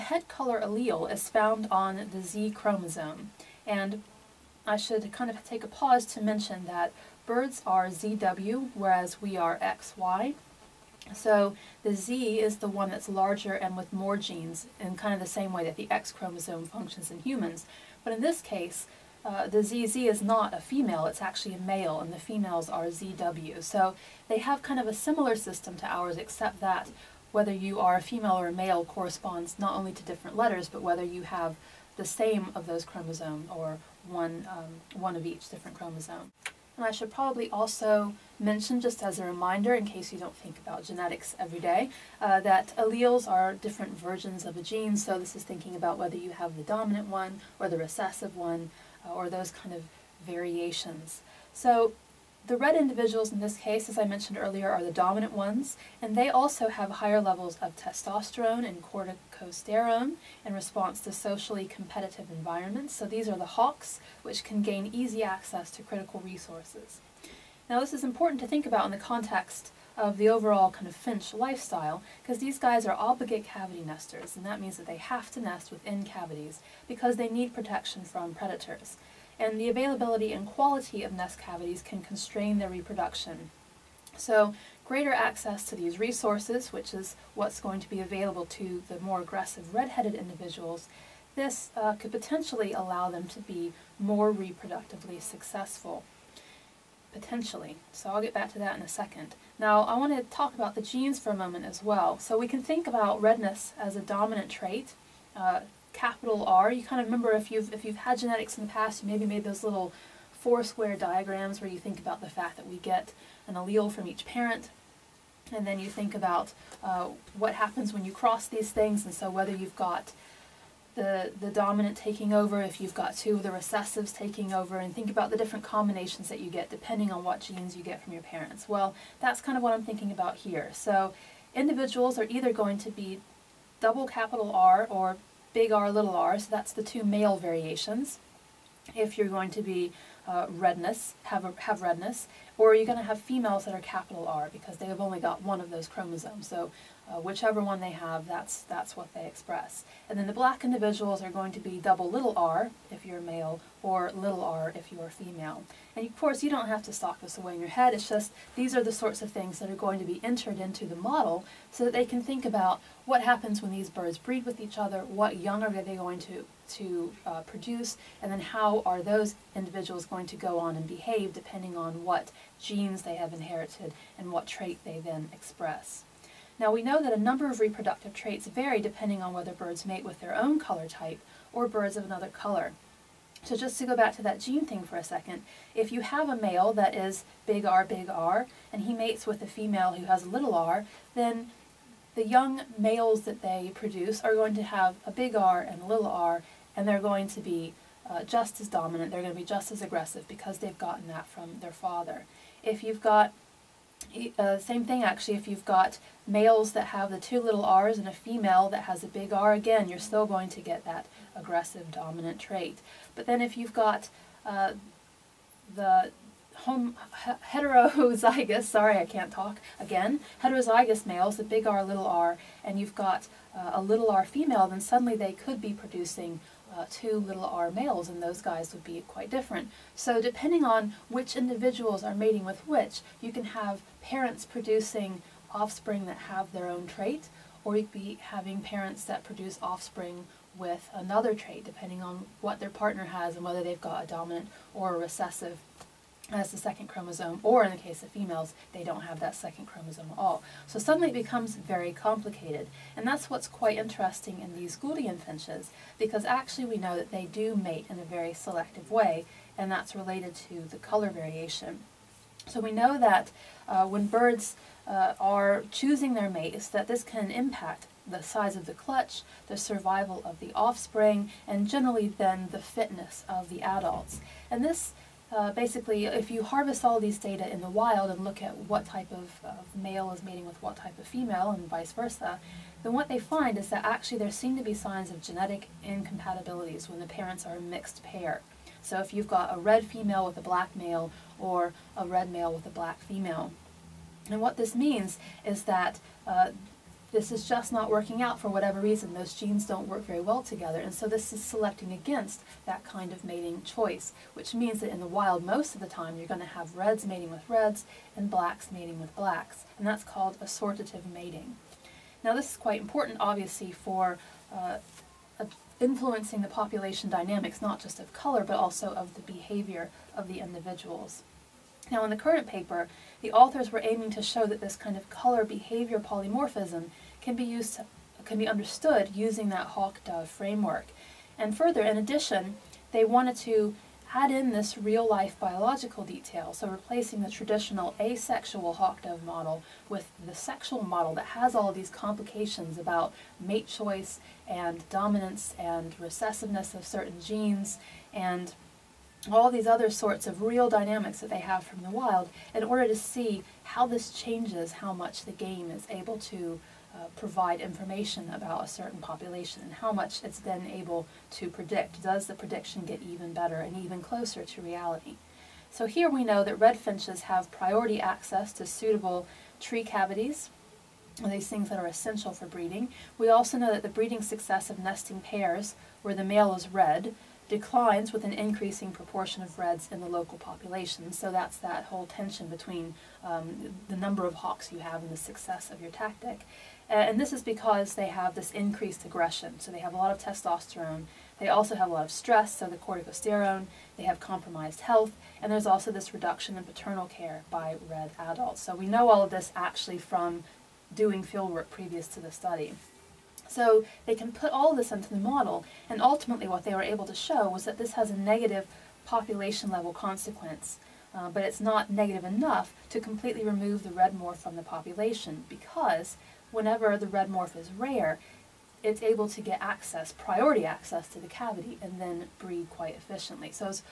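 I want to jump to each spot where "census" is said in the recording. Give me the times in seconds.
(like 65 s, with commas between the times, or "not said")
not said.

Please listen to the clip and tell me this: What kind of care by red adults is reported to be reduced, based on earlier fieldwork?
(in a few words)
paternal care.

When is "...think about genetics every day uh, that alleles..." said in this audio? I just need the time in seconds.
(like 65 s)
40 s.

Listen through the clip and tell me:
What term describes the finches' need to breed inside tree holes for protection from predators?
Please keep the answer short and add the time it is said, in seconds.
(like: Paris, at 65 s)
obligate cavity nesters, at 72 s.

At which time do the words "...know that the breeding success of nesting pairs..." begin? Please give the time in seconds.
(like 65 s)
373 s.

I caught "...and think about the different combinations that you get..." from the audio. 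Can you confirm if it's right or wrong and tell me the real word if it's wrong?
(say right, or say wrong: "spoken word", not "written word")
right.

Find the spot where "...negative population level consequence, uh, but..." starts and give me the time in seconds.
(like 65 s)
408 s.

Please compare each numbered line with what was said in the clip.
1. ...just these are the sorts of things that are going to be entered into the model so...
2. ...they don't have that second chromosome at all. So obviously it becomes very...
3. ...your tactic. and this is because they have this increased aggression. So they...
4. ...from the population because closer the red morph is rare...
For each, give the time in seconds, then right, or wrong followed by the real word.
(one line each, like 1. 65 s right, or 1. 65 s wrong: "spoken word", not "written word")
1. 158 s right
2. 248 s wrong: "suddenly", not "obviously"
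3. 385 s right
4. 414 s wrong: "whenever", not "closer".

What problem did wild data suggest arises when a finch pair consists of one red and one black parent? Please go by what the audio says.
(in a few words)
genetic incompatibilities.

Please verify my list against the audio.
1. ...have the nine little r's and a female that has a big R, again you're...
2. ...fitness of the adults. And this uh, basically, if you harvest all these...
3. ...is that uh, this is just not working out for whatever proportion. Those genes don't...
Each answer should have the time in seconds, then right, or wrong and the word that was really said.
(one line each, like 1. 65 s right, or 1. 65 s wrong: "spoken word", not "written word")
1. 206 s wrong: "two", not "nine"
2. 272 s right
3. 295 s wrong: "reason", not "proportion".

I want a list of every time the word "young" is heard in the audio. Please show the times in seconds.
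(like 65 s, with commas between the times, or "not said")
165 s, 192 s.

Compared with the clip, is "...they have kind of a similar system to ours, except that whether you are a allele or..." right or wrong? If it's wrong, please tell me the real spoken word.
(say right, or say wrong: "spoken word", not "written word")
wrong: "female", not "allele".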